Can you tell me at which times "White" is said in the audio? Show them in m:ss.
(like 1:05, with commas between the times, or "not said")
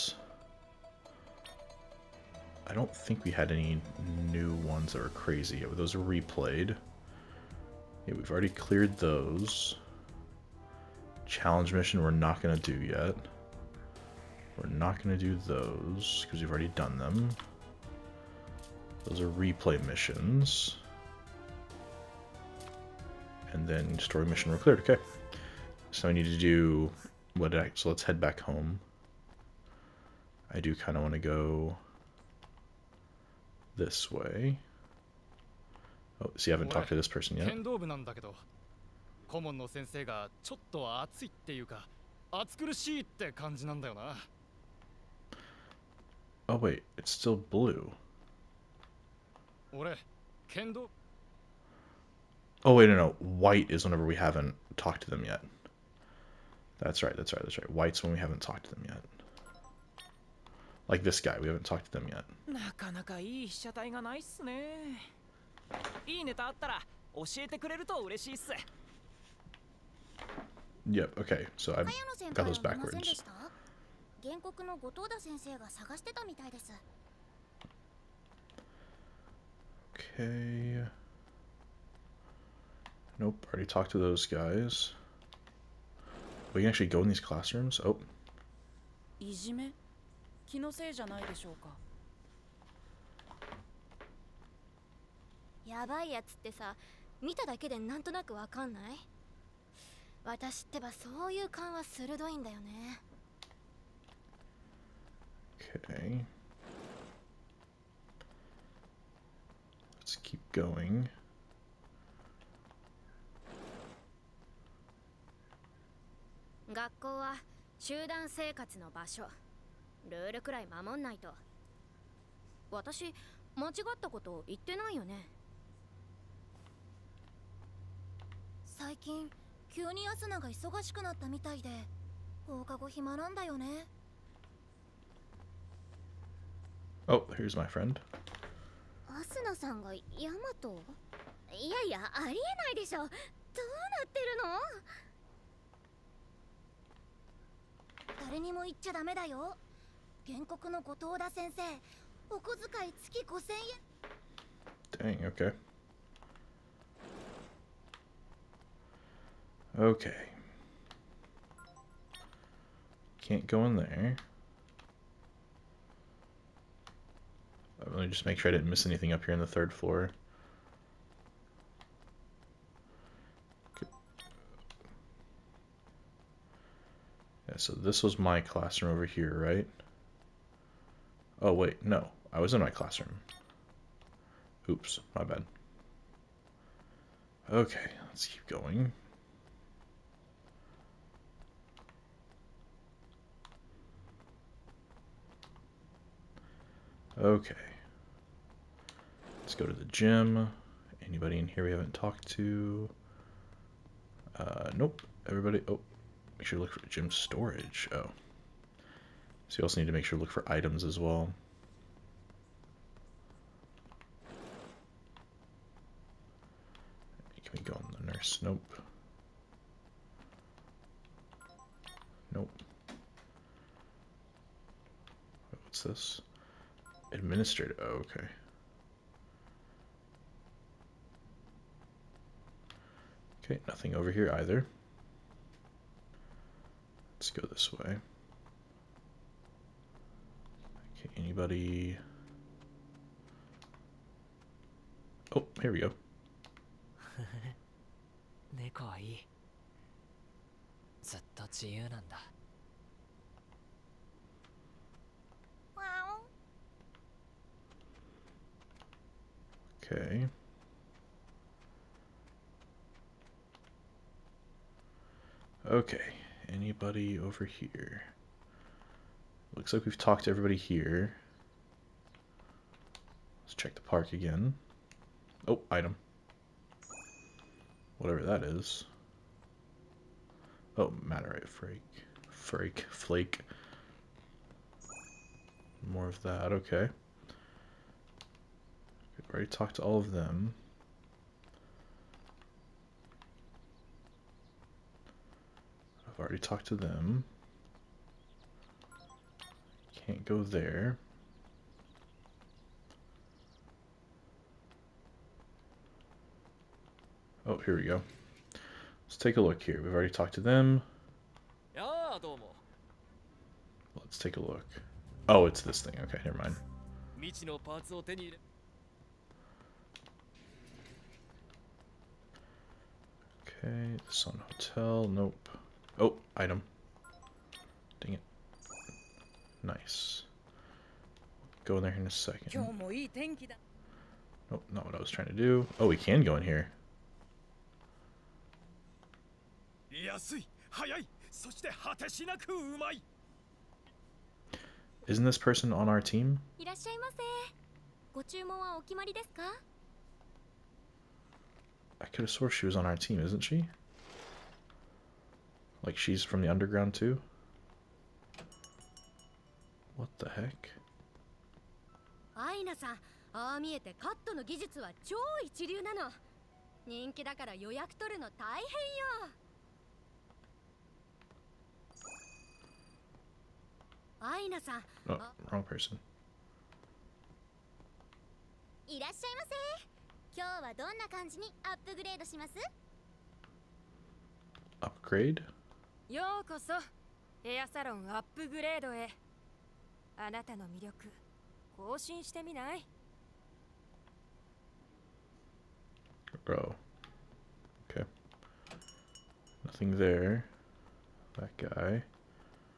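0:53, 0:57.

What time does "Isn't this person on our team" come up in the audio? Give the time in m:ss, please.
5:45.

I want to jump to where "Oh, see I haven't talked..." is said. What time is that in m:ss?
0:36.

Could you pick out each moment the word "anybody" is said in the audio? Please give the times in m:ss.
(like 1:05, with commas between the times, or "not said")
3:21, 4:01, 4:26.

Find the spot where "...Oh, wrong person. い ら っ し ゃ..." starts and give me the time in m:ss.
6:15.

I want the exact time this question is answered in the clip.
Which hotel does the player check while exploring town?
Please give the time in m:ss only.
5:24.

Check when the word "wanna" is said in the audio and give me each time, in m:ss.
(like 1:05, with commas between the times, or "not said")
0:31.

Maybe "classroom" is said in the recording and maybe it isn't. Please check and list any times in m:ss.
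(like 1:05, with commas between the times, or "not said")
1:27, 2:58, 3:02.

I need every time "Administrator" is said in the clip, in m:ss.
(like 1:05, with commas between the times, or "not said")
3:47.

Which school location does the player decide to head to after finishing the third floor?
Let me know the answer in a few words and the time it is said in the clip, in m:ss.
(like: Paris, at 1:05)
the gym, at 3:19.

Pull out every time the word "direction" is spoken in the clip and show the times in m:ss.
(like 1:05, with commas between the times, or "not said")
not said.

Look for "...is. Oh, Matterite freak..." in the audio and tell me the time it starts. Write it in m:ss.
4:38.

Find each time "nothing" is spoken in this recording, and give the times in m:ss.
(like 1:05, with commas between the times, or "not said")
3:53, 6:39.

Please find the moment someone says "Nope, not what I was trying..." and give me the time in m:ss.
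5:34.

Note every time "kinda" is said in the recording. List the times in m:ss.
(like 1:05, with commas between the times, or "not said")
0:30.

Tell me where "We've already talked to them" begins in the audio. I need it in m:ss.
5:09.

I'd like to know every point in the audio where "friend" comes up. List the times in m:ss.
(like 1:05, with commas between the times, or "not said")
2:17.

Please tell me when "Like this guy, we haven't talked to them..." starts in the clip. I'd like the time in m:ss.
1:00.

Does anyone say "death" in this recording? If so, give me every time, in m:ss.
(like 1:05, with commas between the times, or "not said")
not said.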